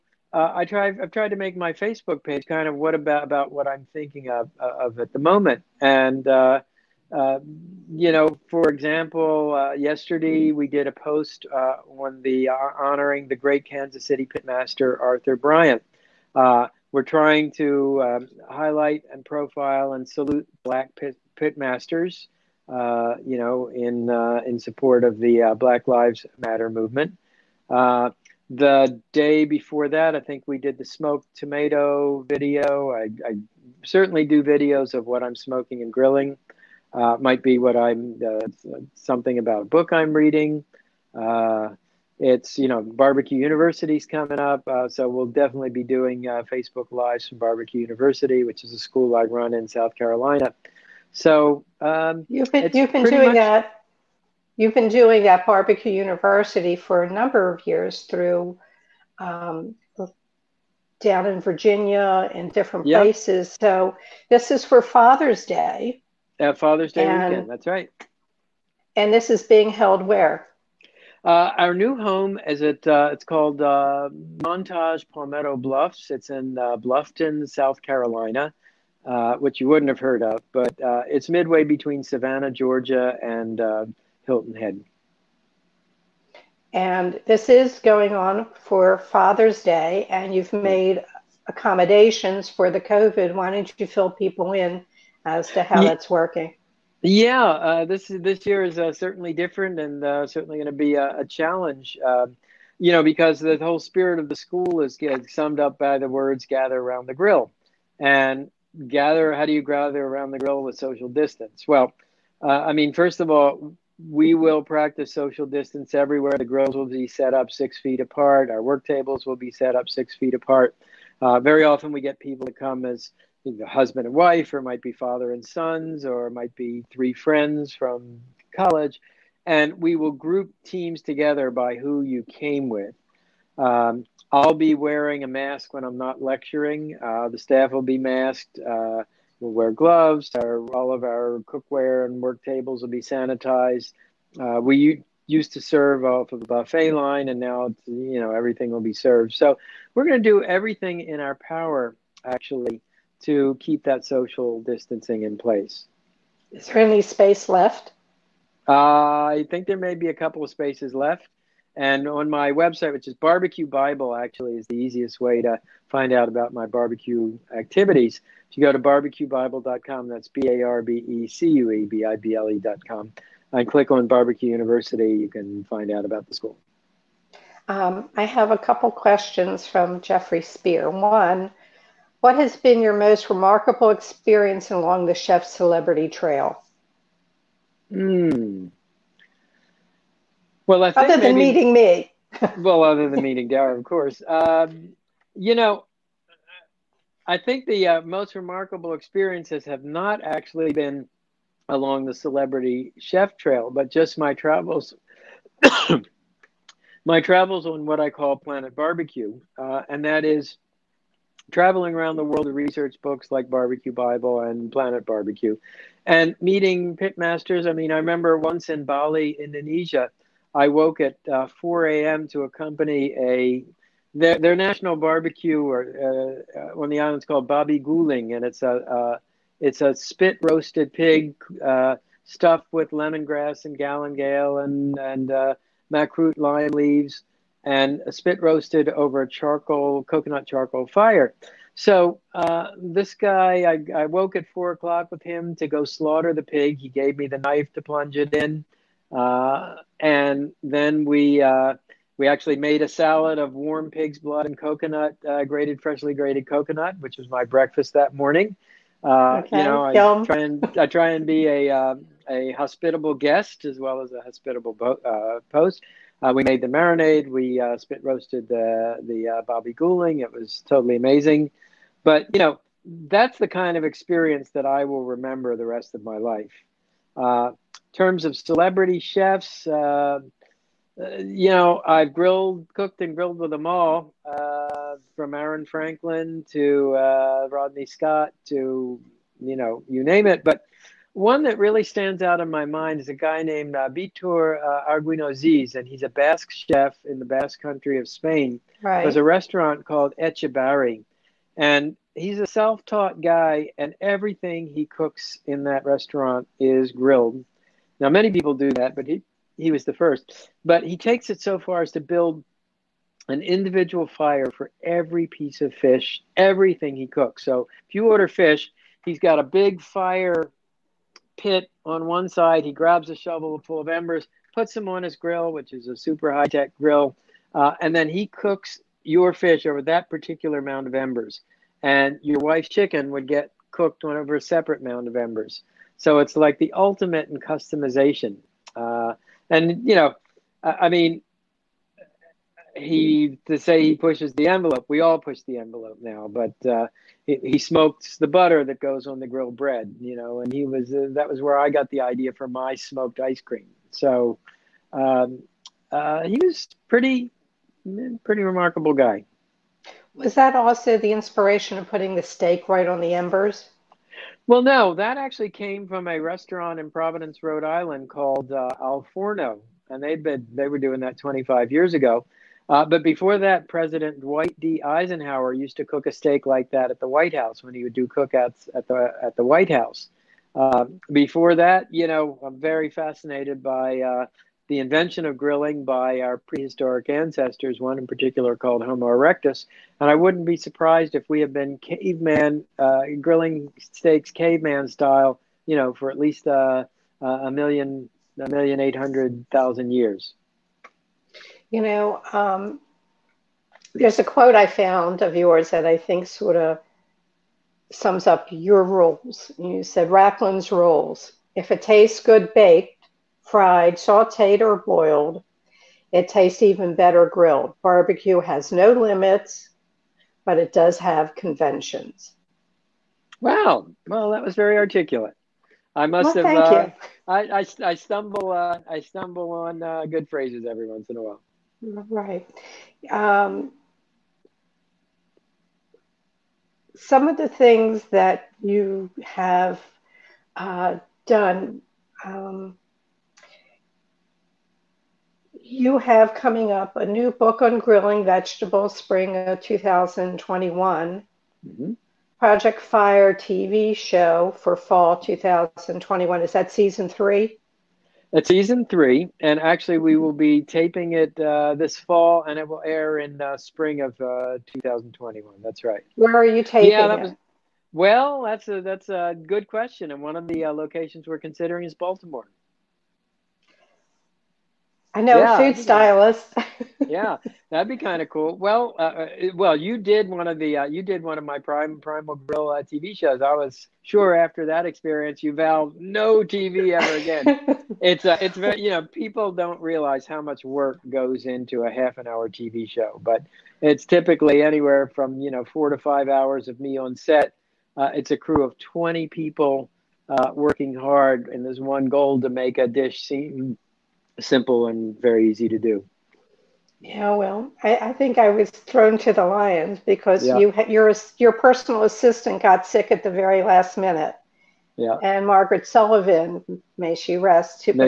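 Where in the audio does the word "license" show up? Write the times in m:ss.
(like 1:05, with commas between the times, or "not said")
not said.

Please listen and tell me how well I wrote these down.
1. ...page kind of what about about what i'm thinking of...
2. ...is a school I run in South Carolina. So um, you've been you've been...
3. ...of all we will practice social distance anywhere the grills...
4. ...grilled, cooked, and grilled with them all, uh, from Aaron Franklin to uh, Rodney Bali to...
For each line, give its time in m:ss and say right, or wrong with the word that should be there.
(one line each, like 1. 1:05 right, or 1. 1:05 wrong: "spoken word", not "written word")
1. 0:02 right
2. 0:48 right
3. 1:53 wrong: "everywhere", not "anywhere"
4. 4:42 wrong: "Scott", not "Bali".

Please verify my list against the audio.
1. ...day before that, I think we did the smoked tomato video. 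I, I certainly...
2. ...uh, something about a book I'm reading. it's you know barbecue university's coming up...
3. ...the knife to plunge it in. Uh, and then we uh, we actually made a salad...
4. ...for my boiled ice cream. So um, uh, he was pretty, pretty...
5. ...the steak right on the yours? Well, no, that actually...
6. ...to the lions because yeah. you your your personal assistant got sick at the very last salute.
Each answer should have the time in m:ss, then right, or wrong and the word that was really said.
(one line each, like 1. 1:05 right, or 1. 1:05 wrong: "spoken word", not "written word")
1. 0:29 right
2. 0:38 right
3. 4:07 right
4. 5:52 wrong: "smoked", not "boiled"
5. 6:02 wrong: "embers", not "yours"
6. 8:29 wrong: "minute", not "salute".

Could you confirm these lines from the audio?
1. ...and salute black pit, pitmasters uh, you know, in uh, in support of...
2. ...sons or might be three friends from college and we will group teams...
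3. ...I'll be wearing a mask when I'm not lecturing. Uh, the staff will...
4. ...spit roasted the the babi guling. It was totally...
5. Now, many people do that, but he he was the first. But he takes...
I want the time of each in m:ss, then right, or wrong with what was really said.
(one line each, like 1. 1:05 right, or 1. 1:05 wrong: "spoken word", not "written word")
1. 0:19 right
2. 2:05 right
3. 2:14 right
4. 4:27 right
5. 5:07 right.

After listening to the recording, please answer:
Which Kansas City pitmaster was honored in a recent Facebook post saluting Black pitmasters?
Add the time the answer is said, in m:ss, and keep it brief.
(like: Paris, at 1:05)
Arthur Bryant, at 0:14.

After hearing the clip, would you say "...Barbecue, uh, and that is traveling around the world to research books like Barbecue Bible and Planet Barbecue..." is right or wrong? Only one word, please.
right.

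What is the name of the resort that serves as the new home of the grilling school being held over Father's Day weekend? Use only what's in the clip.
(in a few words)
Montage Palmetto Bluffs.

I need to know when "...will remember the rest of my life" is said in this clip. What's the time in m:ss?
4:34.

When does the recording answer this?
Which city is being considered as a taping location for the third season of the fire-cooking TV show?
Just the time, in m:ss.
7:51.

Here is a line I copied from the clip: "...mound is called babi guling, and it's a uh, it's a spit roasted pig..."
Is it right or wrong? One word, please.
wrong.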